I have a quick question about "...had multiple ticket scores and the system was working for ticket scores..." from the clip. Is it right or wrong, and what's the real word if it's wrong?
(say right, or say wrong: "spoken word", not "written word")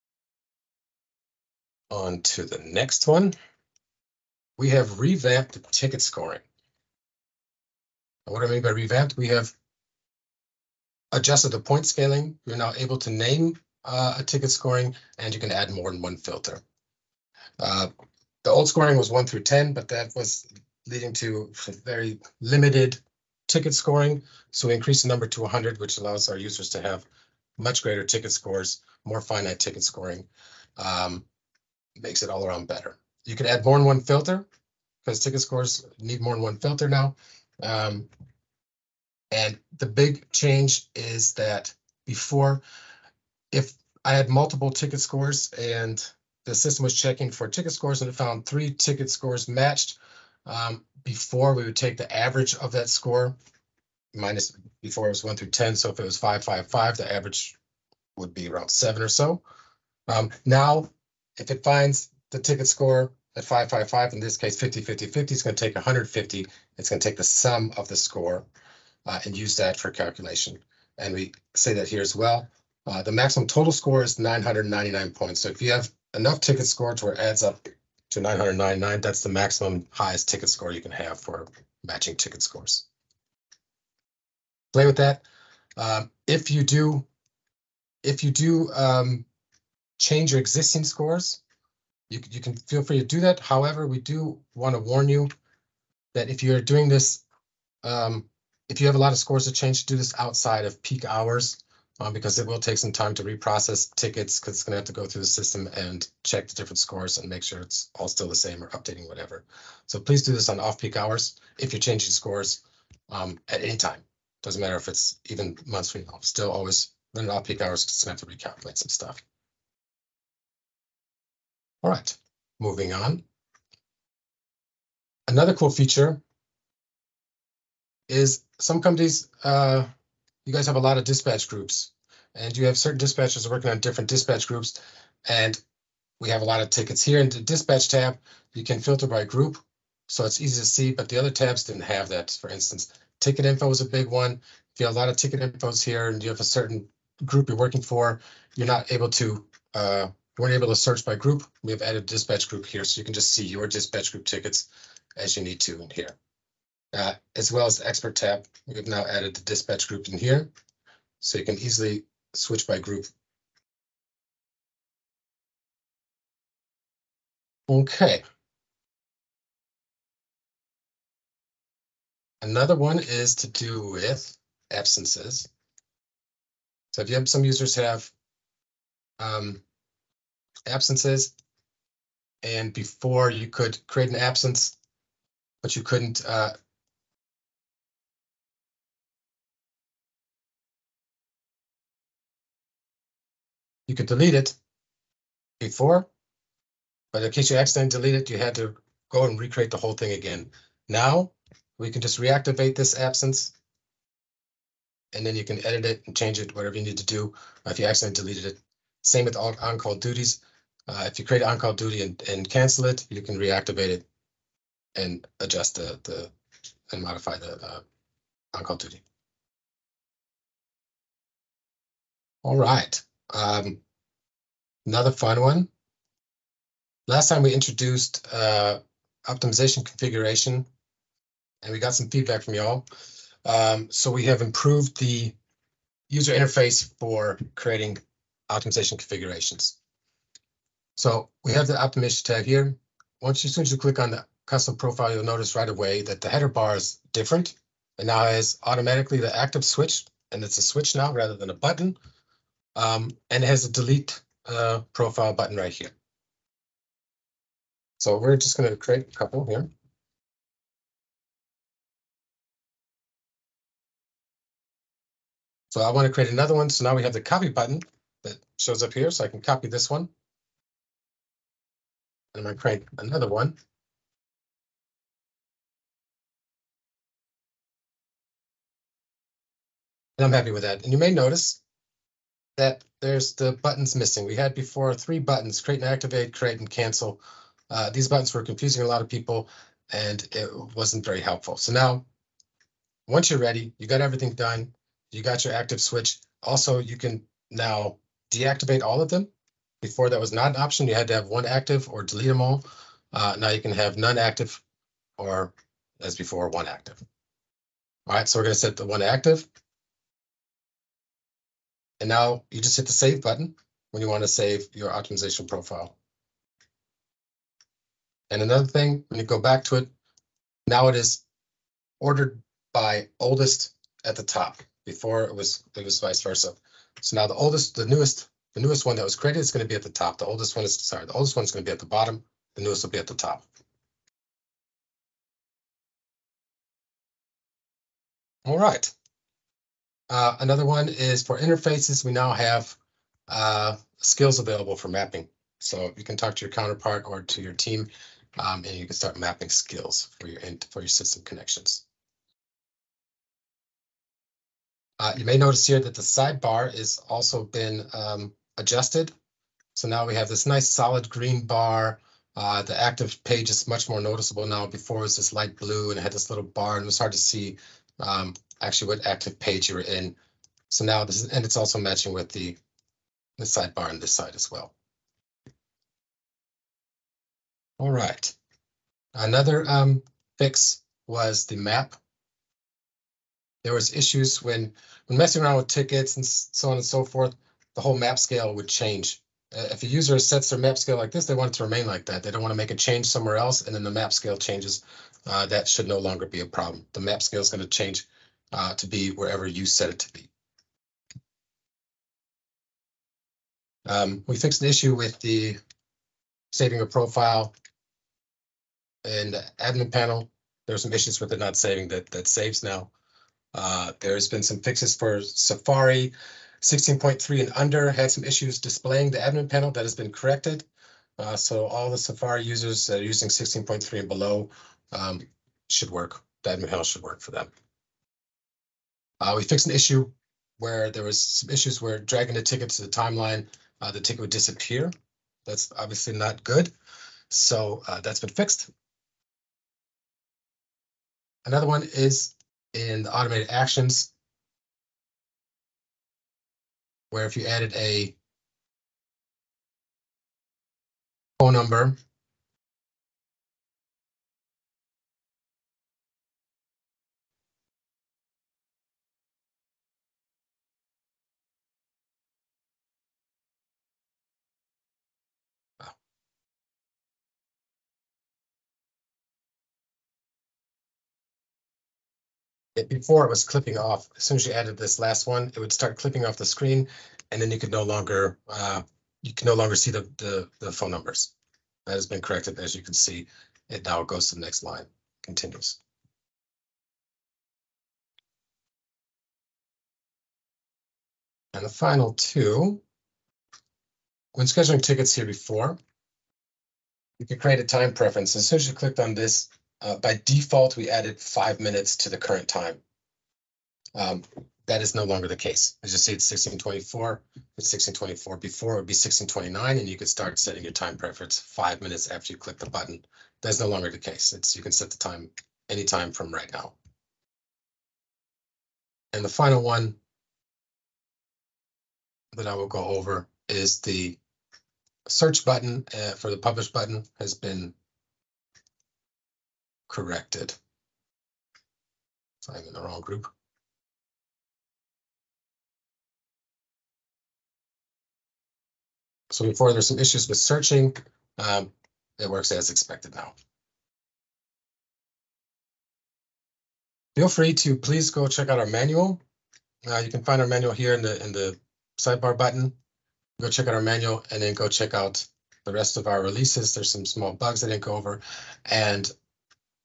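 wrong: "checking", not "working".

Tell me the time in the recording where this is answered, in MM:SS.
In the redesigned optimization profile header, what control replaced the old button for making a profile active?
04:10.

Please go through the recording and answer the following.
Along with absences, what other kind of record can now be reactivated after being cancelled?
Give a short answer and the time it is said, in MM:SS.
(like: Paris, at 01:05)
on-call duties, at 03:29.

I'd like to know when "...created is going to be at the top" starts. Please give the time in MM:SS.
05:29.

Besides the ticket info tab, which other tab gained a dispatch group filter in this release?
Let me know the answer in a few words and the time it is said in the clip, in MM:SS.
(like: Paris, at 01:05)
expert tab, at 02:37.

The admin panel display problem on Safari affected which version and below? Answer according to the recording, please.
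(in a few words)
16.3.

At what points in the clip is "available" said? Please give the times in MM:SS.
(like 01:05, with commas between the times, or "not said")
05:44.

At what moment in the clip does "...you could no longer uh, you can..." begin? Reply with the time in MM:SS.
07:57.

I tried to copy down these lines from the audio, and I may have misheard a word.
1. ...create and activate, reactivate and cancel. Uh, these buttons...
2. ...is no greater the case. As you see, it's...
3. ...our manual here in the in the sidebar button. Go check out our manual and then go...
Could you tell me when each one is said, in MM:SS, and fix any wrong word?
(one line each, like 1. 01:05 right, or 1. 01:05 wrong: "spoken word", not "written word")
1. 04:45 wrong: "create", not "reactivate"
2. 08:24 wrong: "longer", not "greater"
3. 09:10 right.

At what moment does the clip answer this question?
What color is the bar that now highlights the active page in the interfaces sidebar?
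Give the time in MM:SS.
06:00.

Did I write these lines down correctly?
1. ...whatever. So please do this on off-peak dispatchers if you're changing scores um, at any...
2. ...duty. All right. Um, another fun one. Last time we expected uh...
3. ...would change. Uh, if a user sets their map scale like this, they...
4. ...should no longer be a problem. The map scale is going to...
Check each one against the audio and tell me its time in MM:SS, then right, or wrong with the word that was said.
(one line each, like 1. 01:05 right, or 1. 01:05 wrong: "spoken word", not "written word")
1. 01:49 wrong: "hours", not "dispatchers"
2. 03:38 wrong: "introduced", not "expected"
3. 06:28 right
4. 06:35 right.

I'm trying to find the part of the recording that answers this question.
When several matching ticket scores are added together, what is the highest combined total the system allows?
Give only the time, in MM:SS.
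01:13.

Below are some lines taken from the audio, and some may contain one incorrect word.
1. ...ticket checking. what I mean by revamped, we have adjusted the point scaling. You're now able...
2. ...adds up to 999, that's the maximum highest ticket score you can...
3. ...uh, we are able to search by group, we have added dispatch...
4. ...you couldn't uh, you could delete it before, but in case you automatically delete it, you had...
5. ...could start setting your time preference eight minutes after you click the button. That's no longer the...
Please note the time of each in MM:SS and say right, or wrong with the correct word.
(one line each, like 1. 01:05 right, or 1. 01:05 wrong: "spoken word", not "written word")
1. 00:05 wrong: "scoring", not "checking"
2. 01:17 right
3. 02:29 right
4. 03:05 wrong: "accidentally", not "automatically"
5. 08:29 wrong: "five", not "eight".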